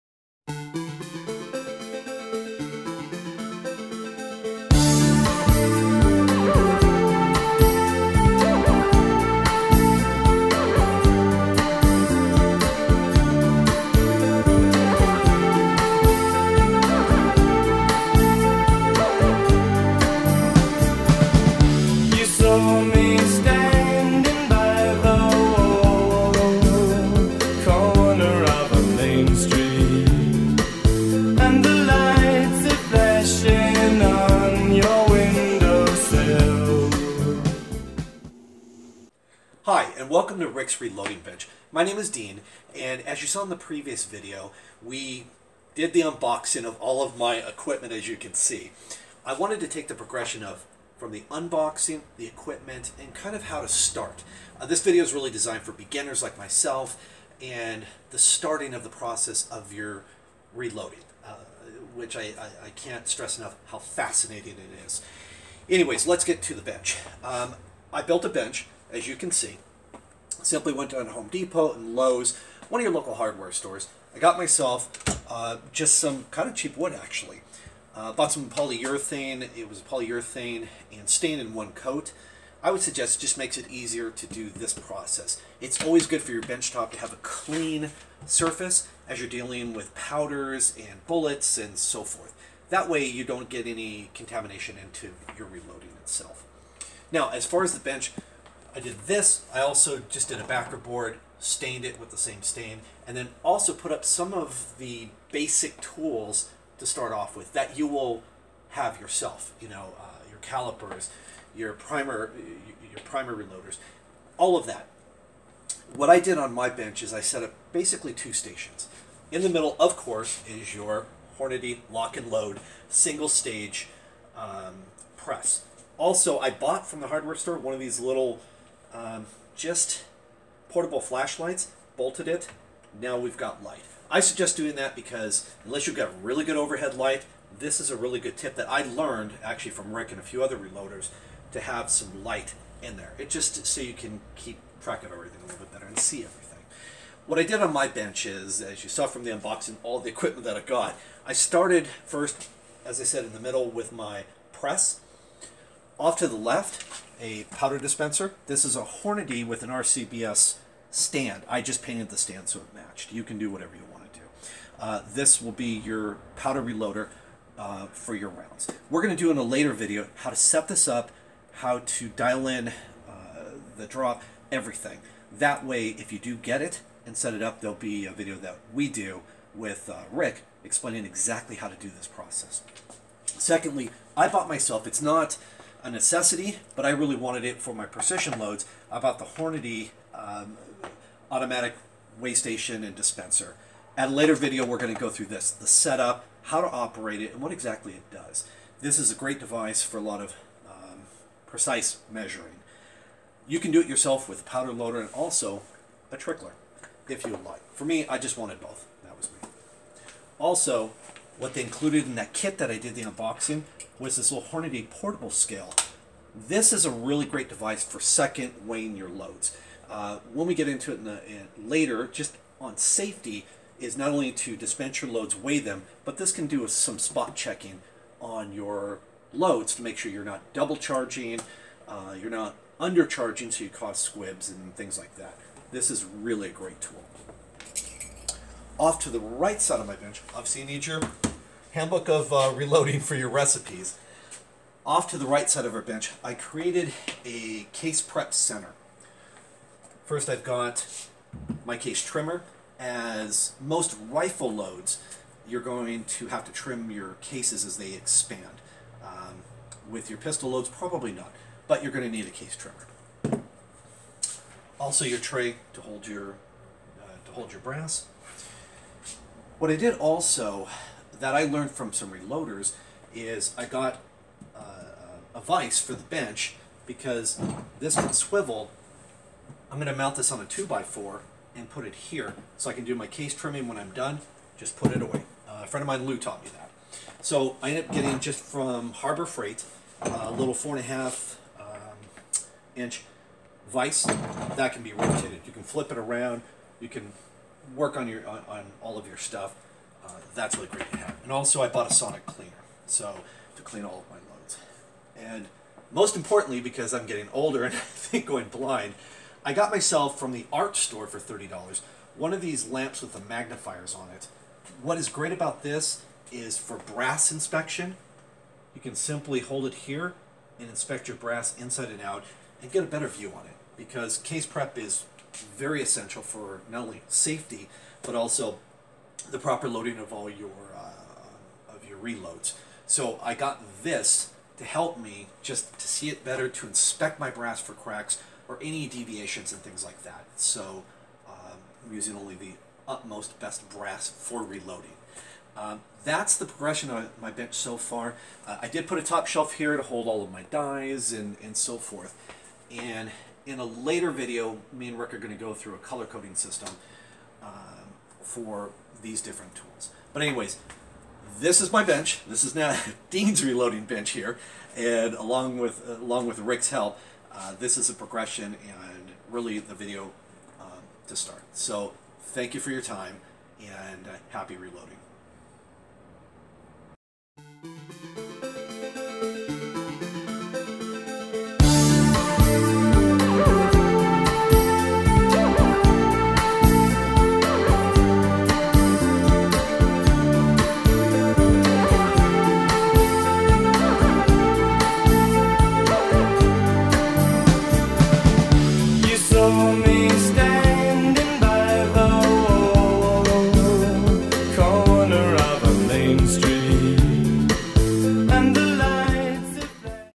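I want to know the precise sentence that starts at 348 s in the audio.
Uh, I did put a top shelf here to hold all of my dies and, and so forth.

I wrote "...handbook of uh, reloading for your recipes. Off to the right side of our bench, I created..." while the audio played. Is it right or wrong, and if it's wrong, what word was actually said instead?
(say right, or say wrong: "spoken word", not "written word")
right.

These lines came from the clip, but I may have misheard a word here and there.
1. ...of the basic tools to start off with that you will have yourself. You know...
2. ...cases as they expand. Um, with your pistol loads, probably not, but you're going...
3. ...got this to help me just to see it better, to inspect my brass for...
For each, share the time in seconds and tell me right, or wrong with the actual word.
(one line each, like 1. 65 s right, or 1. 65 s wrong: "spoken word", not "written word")
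1. 104 s right
2. 257 s right
3. 333 s right.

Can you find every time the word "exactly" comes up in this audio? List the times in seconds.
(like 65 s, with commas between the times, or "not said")
181 s, 197 s.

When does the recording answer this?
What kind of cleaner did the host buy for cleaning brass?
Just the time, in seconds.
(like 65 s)
301 s.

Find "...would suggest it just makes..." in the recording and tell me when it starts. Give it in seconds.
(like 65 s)
82 s.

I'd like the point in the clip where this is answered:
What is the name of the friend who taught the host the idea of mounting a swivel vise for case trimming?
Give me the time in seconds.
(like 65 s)
286 s.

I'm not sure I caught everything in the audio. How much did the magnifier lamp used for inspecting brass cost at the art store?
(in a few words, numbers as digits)
$30.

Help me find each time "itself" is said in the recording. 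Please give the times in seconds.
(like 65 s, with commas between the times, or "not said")
96 s.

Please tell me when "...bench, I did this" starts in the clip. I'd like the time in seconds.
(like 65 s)
97 s.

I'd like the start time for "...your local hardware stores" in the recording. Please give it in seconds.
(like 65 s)
72 s.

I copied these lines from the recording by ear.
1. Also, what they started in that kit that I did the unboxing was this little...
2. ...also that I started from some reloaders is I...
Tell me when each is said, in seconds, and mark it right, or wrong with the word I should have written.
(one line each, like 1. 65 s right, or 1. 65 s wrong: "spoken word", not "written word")
1. 210 s wrong: "included", not "started"
2. 269 s wrong: "learned", not "started".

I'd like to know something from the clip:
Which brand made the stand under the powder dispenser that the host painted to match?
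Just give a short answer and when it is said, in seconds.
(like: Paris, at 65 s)
RCBS, at 159 s.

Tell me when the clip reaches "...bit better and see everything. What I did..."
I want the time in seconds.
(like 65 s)
145 s.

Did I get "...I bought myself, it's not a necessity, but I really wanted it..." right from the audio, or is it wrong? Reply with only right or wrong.
right.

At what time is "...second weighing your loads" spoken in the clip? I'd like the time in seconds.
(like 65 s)
217 s.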